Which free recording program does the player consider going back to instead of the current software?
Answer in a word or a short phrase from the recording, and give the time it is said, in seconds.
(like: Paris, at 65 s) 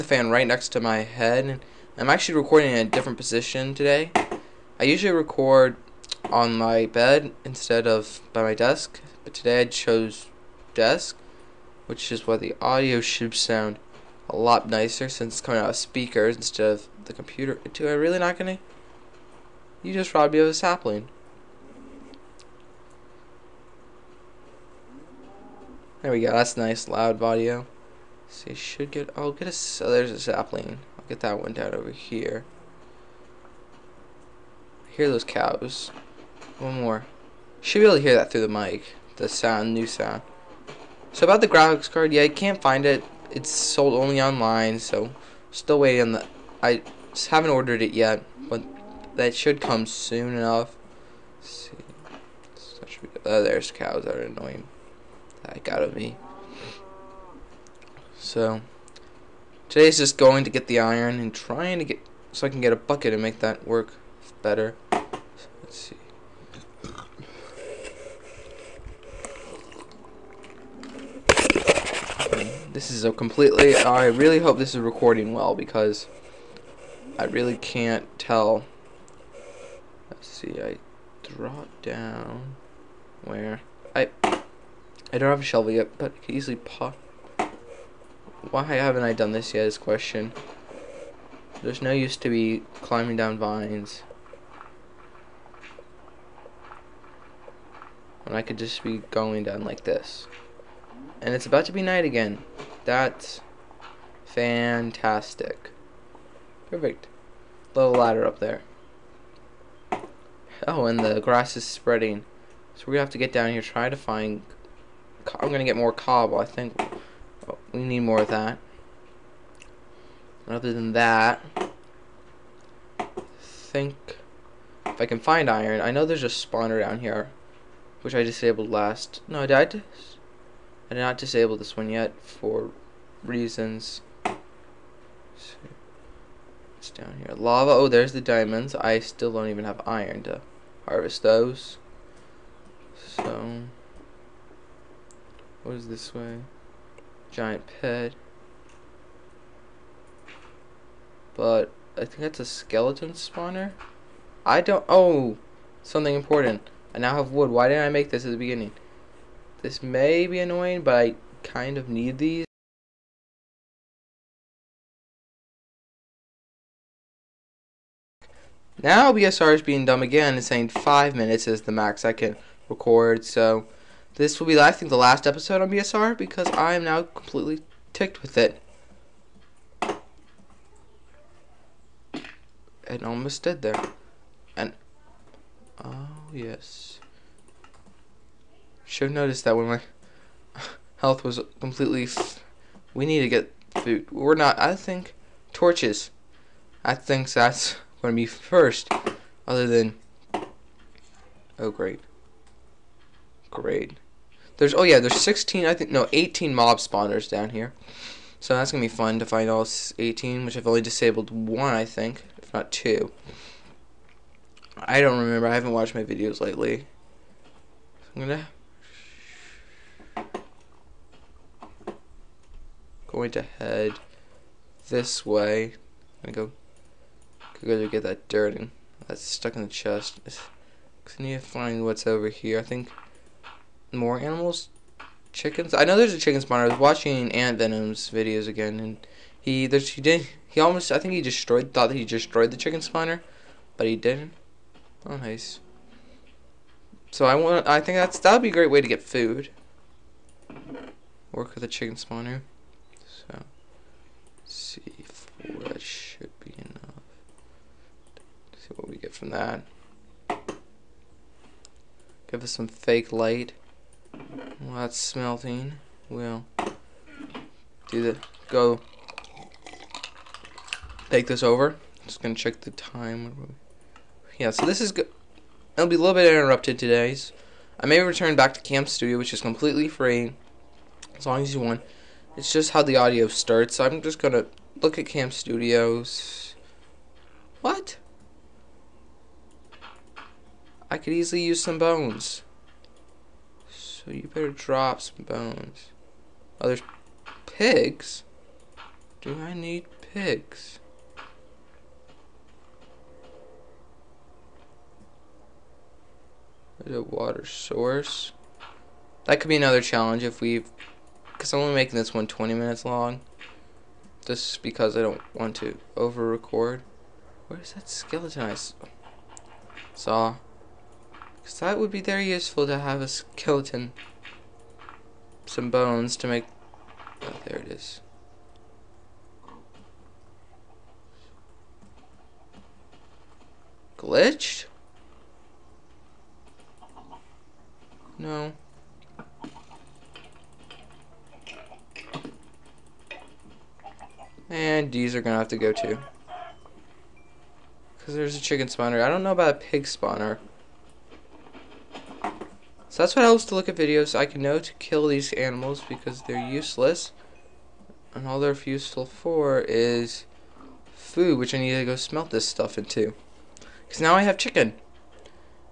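Cam Studio, at 278 s.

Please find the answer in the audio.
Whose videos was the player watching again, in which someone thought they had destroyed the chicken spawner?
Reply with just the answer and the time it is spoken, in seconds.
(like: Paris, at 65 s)
Ant Venom, at 237 s.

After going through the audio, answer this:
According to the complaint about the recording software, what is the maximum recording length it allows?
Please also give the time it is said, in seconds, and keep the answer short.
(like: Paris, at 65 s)
5 minutes, at 170 s.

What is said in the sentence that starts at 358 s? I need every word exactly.
And all they're useful for is food, which I need to go smelt this stuff into.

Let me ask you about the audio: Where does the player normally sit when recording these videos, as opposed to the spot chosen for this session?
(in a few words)
On my bed.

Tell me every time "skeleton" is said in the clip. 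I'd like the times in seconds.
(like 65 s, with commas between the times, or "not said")
152 s, 317 s, 323 s.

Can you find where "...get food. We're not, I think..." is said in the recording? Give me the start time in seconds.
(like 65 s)
193 s.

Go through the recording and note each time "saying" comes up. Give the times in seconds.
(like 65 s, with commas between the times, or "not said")
170 s.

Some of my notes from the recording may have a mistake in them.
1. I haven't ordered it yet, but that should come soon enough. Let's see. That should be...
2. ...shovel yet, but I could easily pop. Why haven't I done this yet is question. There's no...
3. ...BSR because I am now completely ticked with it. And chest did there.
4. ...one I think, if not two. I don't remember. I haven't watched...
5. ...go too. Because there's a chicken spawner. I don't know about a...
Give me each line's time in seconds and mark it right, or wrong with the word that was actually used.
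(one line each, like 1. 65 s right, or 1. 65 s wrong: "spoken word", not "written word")
1. 46 s right
2. 85 s right
3. 175 s wrong: "almost", not "chest"
4. 211 s right
5. 345 s right.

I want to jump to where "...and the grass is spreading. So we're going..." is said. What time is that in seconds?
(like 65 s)
110 s.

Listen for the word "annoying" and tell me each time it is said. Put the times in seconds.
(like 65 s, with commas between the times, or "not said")
54 s, 160 s.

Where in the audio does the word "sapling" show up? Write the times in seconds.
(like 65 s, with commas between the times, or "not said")
20 s, 30 s.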